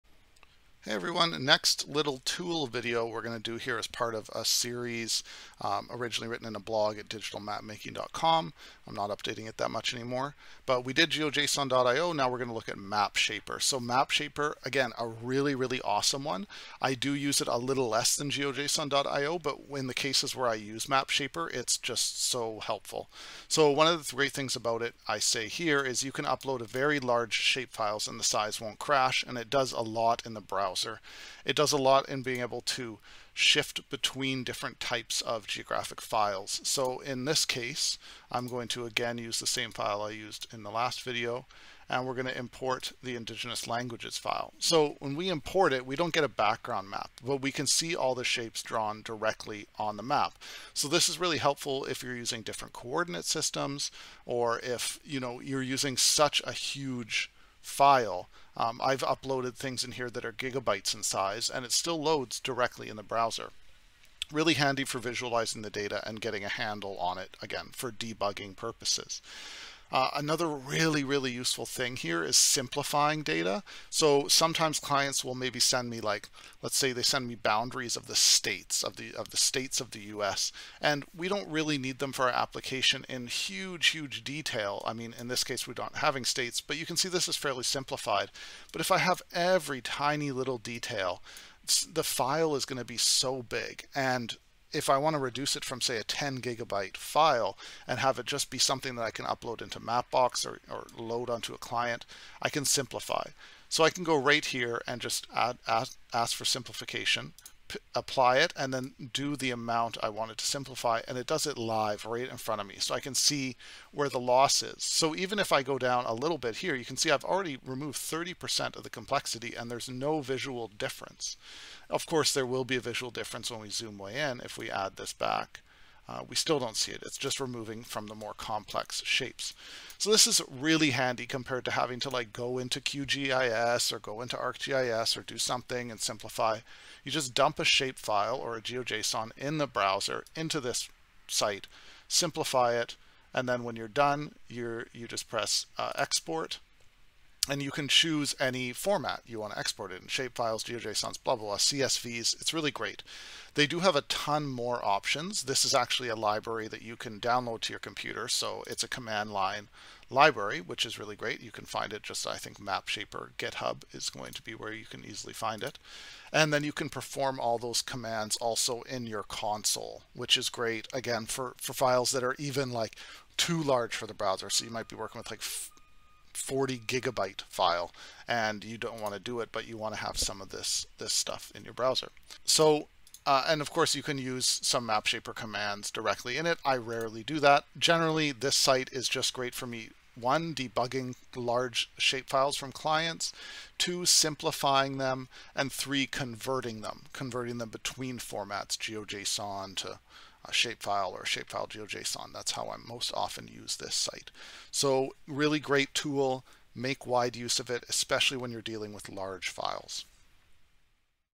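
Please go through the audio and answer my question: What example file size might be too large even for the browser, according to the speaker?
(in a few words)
40 gigabytes.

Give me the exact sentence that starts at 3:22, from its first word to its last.
That's how I most often use this site.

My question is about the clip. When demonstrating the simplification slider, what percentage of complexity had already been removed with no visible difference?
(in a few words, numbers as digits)
30%.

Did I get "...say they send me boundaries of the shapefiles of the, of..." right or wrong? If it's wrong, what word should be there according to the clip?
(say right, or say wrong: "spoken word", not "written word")
wrong: "states", not "shapefiles".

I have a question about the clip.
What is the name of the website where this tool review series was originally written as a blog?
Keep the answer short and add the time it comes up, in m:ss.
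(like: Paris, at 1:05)
digitalmapmaking.com, at 0:07.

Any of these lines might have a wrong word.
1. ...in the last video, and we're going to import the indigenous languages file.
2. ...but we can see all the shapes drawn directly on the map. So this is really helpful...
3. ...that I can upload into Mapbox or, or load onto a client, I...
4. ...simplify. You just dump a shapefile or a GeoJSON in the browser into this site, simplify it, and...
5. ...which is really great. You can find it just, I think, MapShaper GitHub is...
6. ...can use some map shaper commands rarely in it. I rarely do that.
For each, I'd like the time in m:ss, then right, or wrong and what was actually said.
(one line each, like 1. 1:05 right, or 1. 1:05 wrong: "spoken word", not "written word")
1. 0:40 right
2. 0:47 right
3. 1:38 right
4. 2:15 right
5. 2:40 right
6. 3:04 wrong: "directly", not "rarely".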